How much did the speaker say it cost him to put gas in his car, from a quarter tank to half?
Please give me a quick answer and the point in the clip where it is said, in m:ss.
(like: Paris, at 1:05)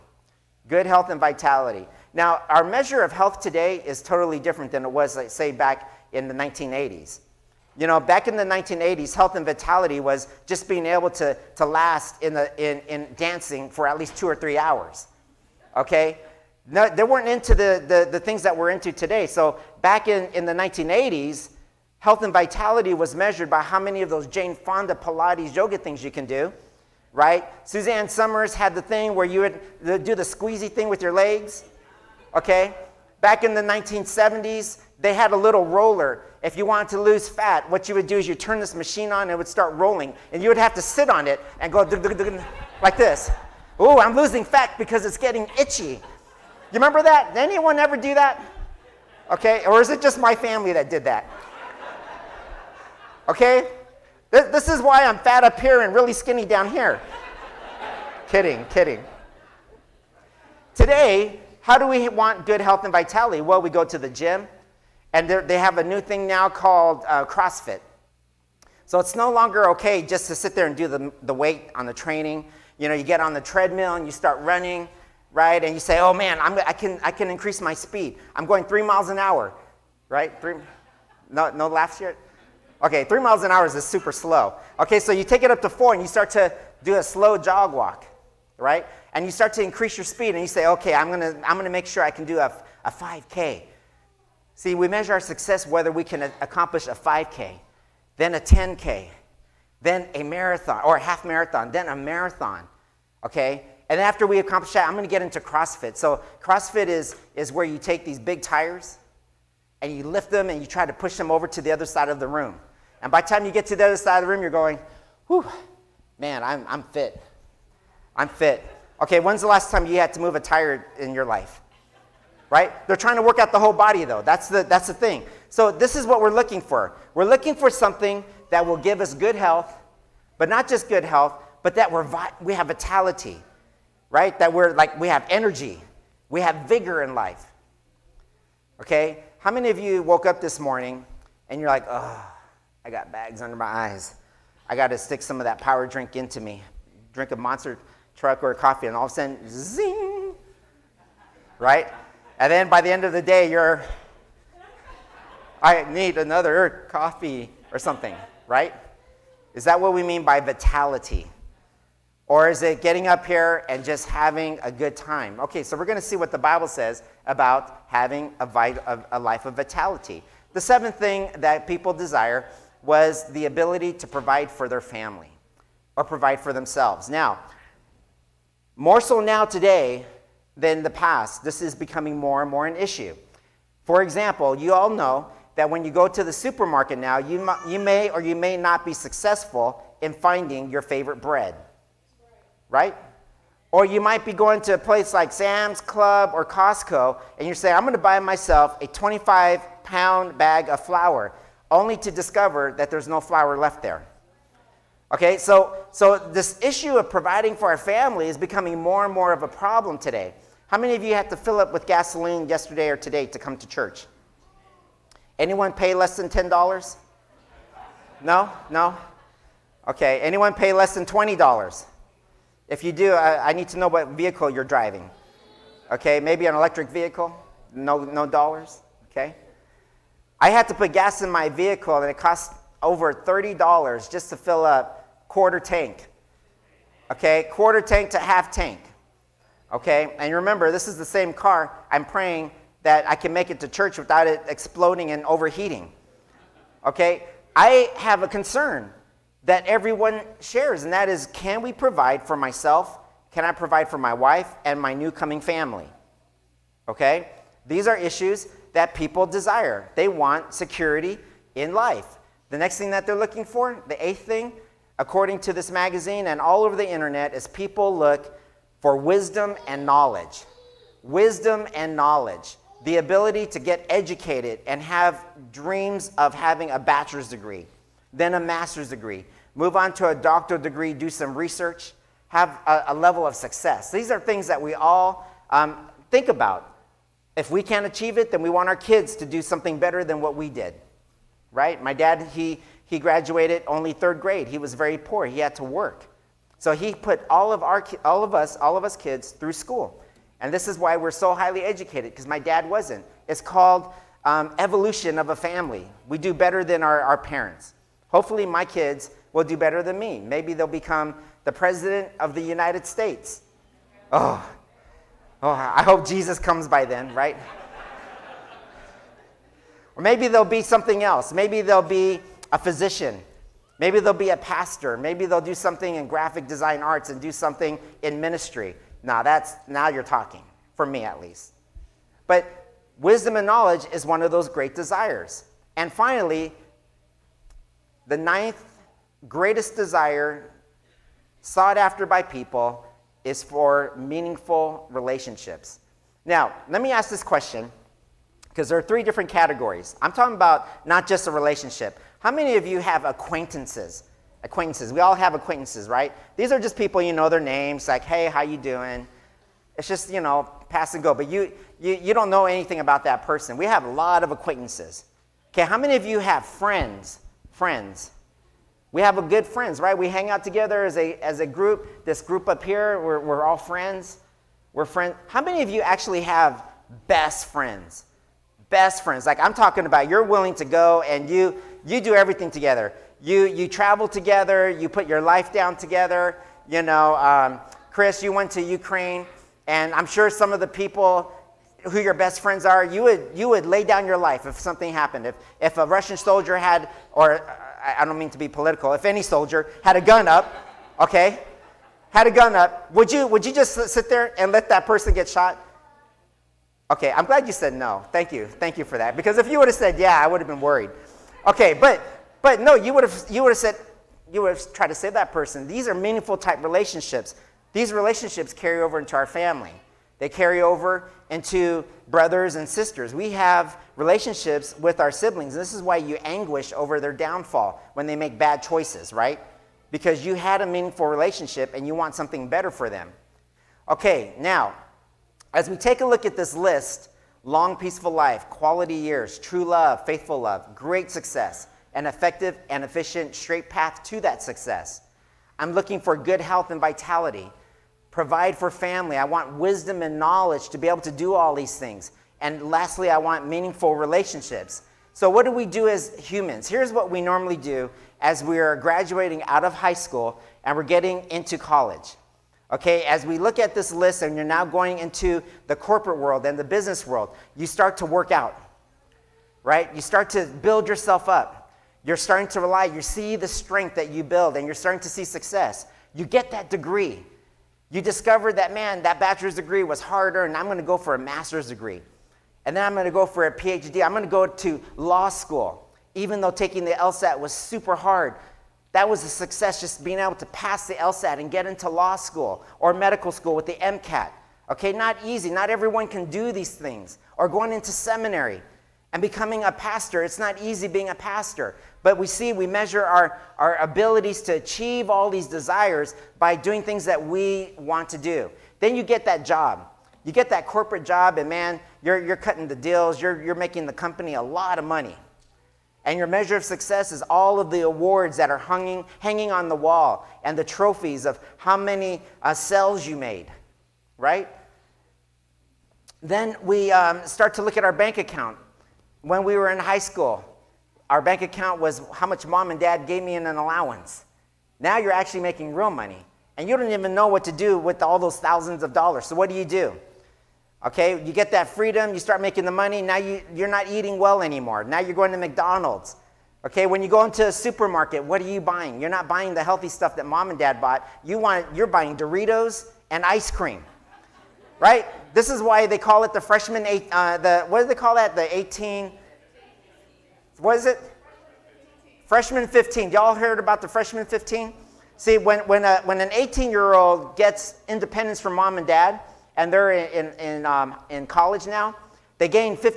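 over $30, at 3:52.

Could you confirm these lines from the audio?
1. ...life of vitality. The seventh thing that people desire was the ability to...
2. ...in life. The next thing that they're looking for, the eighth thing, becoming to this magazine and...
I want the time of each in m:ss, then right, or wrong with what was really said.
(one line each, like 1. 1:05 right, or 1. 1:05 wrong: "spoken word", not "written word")
1. 2:49 right
2. 4:21 wrong: "according", not "becoming".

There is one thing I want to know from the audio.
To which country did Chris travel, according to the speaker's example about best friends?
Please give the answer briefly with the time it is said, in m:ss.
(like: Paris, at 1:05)
Ukraine, at 6:28.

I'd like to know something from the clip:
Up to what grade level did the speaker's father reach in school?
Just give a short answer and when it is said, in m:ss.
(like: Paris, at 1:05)
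third grade, at 4:53.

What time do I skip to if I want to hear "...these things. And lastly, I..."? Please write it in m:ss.
7:31.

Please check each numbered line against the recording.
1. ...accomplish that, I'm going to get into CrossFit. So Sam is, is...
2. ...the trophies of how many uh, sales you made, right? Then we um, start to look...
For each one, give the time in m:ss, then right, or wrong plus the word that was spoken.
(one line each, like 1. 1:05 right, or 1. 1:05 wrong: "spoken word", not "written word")
1. 1:44 wrong: "CrossFit", not "Sam"
2. 8:40 right.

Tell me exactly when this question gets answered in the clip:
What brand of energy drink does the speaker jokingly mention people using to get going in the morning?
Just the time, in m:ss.
2:27.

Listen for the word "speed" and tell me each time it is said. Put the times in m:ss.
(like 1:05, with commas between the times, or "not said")
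1:17, 1:30.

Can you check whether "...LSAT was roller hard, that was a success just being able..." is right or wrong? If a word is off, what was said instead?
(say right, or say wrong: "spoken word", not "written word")
wrong: "super", not "roller".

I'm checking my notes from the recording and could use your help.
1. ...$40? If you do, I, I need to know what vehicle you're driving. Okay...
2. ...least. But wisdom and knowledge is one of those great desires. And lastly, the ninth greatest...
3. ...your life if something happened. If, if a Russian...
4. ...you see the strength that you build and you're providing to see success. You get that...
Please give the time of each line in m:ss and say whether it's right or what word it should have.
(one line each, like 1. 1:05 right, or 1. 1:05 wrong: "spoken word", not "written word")
1. 3:41 wrong: "20", not "40"
2. 5:31 wrong: "finally", not "lastly"
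3. 6:34 right
4. 7:52 wrong: "starting", not "providing".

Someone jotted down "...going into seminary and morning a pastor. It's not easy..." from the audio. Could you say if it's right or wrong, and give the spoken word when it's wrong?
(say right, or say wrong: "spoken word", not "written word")
wrong: "becoming", not "morning".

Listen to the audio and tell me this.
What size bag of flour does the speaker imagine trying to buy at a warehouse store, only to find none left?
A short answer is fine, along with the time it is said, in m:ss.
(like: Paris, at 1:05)
25 pound, at 3:18.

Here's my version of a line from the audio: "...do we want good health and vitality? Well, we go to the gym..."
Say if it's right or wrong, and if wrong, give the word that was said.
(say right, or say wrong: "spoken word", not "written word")
right.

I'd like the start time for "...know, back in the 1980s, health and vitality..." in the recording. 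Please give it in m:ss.
0:07.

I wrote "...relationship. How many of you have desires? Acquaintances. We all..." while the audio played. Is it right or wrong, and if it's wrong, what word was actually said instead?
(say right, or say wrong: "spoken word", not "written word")
wrong: "acquaintances", not "desires".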